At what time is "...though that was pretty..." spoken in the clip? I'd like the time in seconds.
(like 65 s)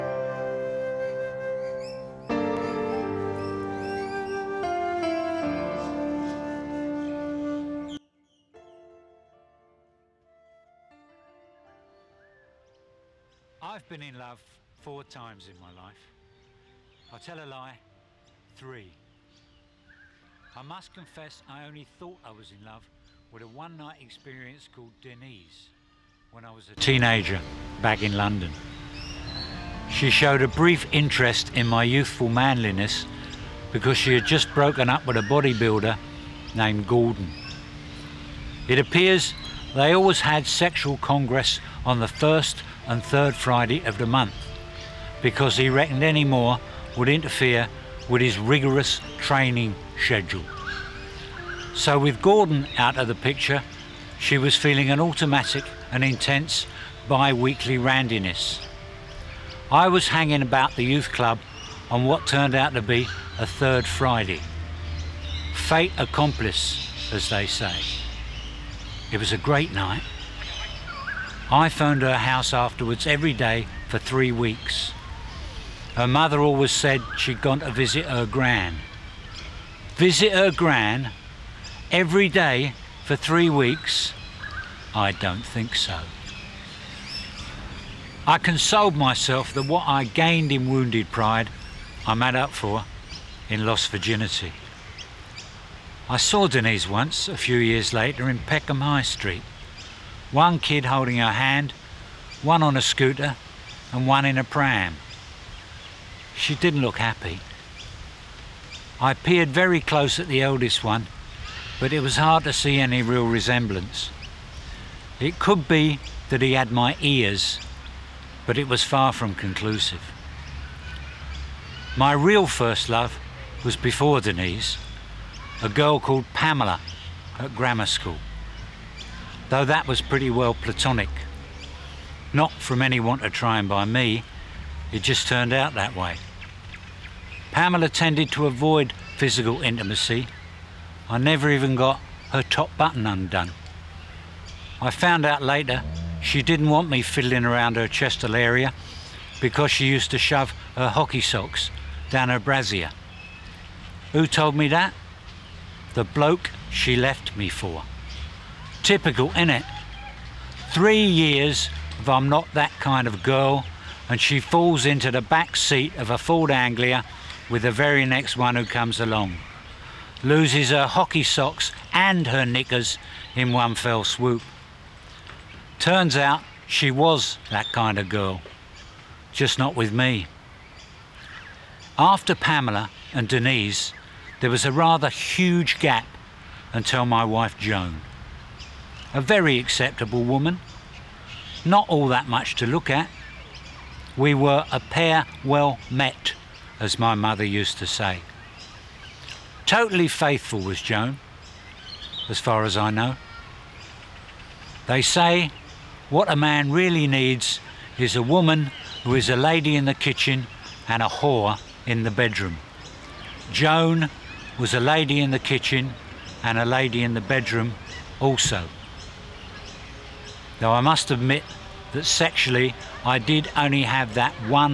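129 s.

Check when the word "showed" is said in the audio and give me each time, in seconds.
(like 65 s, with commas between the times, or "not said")
30 s.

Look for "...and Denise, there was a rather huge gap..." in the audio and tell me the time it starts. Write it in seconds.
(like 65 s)
183 s.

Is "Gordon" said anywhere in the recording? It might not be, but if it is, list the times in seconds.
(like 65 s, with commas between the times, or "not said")
36 s, 52 s.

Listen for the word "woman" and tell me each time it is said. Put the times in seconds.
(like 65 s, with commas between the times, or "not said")
190 s, 208 s.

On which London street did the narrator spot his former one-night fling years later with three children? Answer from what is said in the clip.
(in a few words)
Peckham High Street.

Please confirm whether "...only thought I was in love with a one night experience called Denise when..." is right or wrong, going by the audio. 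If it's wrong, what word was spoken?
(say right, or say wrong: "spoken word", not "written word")
right.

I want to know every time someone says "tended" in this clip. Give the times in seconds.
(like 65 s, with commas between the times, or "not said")
137 s.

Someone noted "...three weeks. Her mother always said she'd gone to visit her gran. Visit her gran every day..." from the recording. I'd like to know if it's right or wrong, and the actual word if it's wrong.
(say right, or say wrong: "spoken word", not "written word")
right.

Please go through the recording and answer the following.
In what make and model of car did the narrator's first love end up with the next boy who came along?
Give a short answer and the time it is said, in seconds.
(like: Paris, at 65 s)
Ford Anglia, at 166 s.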